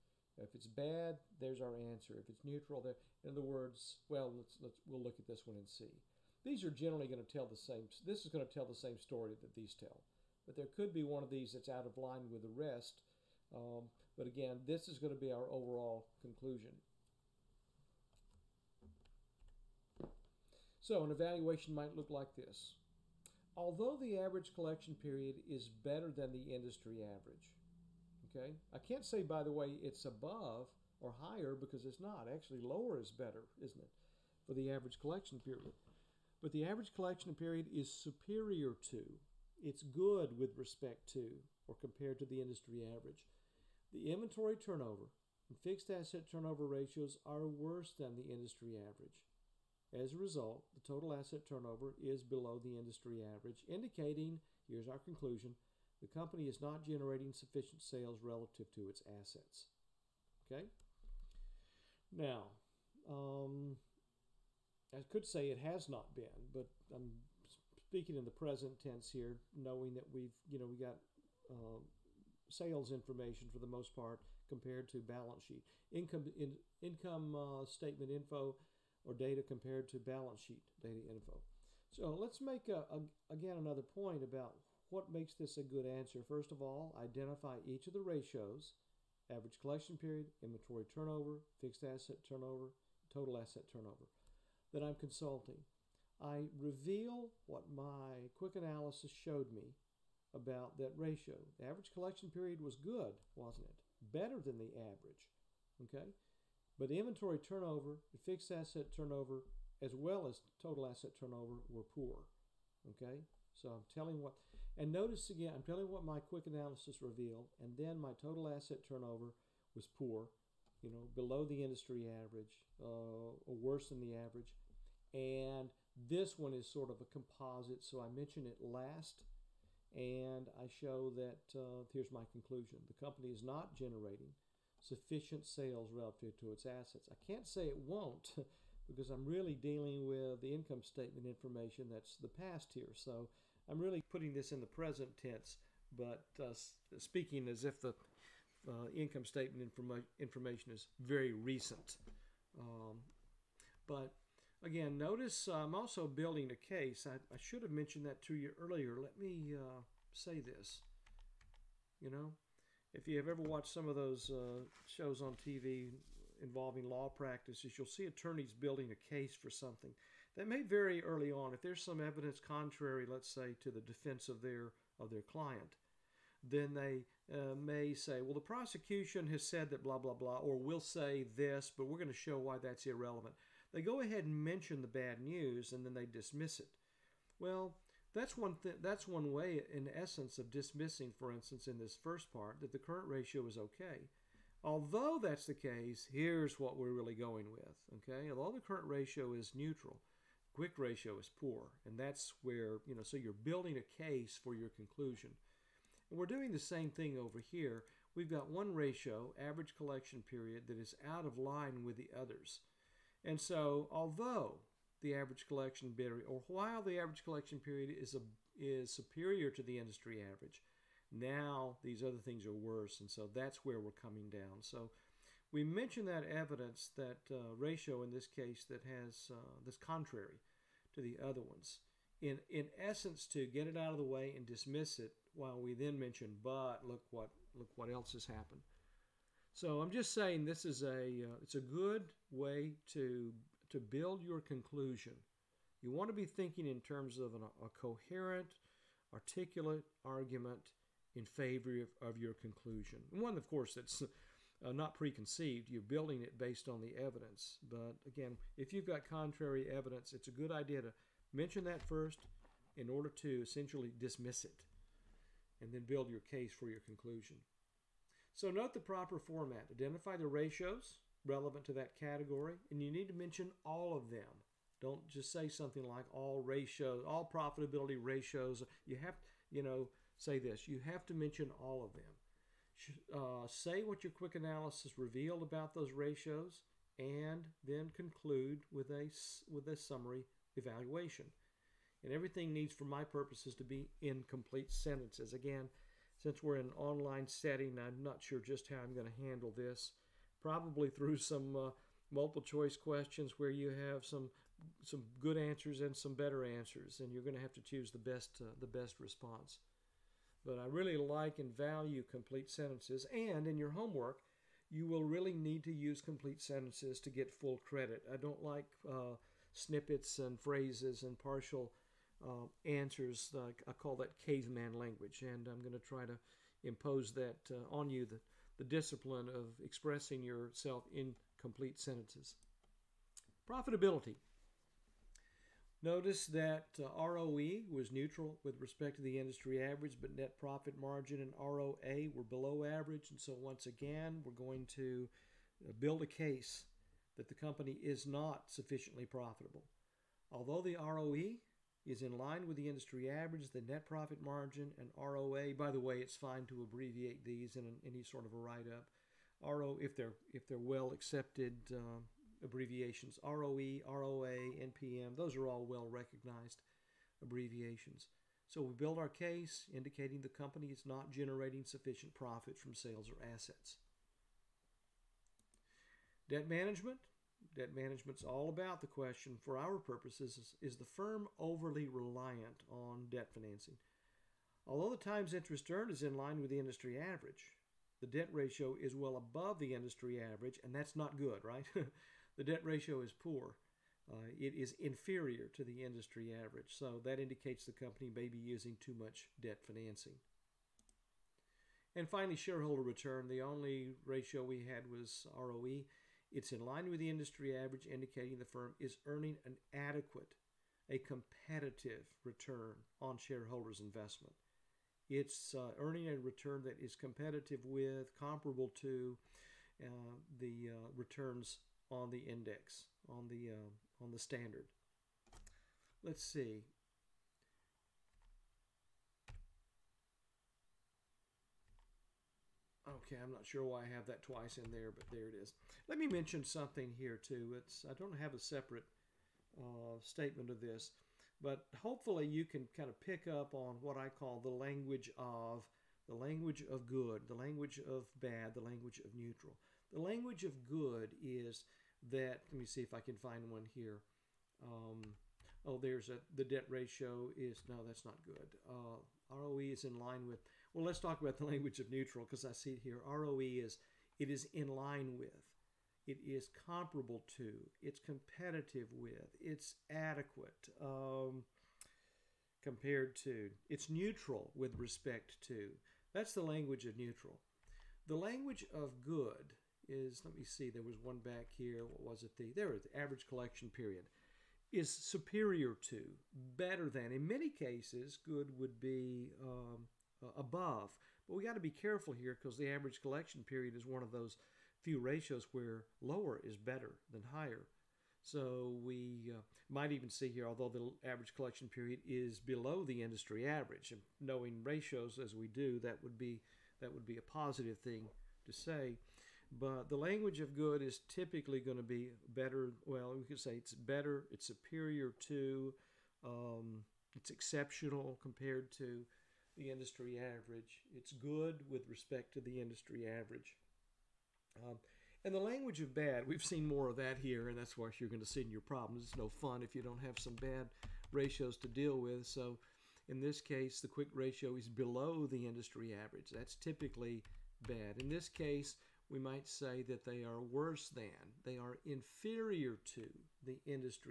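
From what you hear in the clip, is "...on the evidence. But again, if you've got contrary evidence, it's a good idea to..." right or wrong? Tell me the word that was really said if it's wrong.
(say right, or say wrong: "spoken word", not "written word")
right.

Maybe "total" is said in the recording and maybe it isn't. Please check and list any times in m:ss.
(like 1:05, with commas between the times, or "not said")
0:50, 1:33, 1:50, 1:58.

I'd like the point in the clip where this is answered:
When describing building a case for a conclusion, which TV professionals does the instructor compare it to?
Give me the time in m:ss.
2:48.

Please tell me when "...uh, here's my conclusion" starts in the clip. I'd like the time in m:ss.
2:11.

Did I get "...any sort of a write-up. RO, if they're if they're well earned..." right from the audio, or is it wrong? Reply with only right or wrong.
wrong.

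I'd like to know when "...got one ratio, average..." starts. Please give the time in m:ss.
3:28.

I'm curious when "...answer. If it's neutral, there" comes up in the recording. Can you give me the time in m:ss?
0:01.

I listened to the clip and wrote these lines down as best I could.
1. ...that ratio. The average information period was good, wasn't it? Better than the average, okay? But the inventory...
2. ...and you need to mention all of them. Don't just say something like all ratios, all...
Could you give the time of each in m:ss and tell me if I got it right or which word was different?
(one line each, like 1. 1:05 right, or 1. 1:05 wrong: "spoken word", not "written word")
1. 1:40 wrong: "collection", not "information"
2. 4:32 right.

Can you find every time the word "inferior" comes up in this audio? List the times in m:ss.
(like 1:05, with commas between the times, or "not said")
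6:34, 9:01.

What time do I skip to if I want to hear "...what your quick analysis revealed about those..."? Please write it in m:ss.
4:43.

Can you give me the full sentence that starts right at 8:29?
But the language of good is typically going to be better.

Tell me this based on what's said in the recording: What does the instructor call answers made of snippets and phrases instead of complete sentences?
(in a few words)
caveman language.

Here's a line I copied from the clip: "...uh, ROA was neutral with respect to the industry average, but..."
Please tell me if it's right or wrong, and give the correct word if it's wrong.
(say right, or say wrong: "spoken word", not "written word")
wrong: "ROE", not "ROA".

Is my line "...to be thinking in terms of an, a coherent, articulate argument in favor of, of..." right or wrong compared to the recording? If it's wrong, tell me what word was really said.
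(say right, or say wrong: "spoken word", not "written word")
right.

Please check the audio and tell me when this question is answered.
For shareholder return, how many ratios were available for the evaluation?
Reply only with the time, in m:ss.
6:43.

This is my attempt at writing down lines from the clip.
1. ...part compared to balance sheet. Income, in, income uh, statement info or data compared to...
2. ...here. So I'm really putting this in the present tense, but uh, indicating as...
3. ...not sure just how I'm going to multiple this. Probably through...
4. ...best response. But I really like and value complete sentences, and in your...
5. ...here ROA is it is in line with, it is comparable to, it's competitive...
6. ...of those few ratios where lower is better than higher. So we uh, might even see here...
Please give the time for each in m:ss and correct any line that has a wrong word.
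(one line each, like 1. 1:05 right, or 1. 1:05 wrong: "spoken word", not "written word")
1. 1:13 right
2. 2:22 wrong: "speaking", not "indicating"
3. 4:58 wrong: "handle", not "multiple"
4. 5:08 right
5. 7:42 wrong: "ROE", not "ROA"
6. 8:14 right.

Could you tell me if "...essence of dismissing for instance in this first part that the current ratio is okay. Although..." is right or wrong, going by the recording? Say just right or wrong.
right.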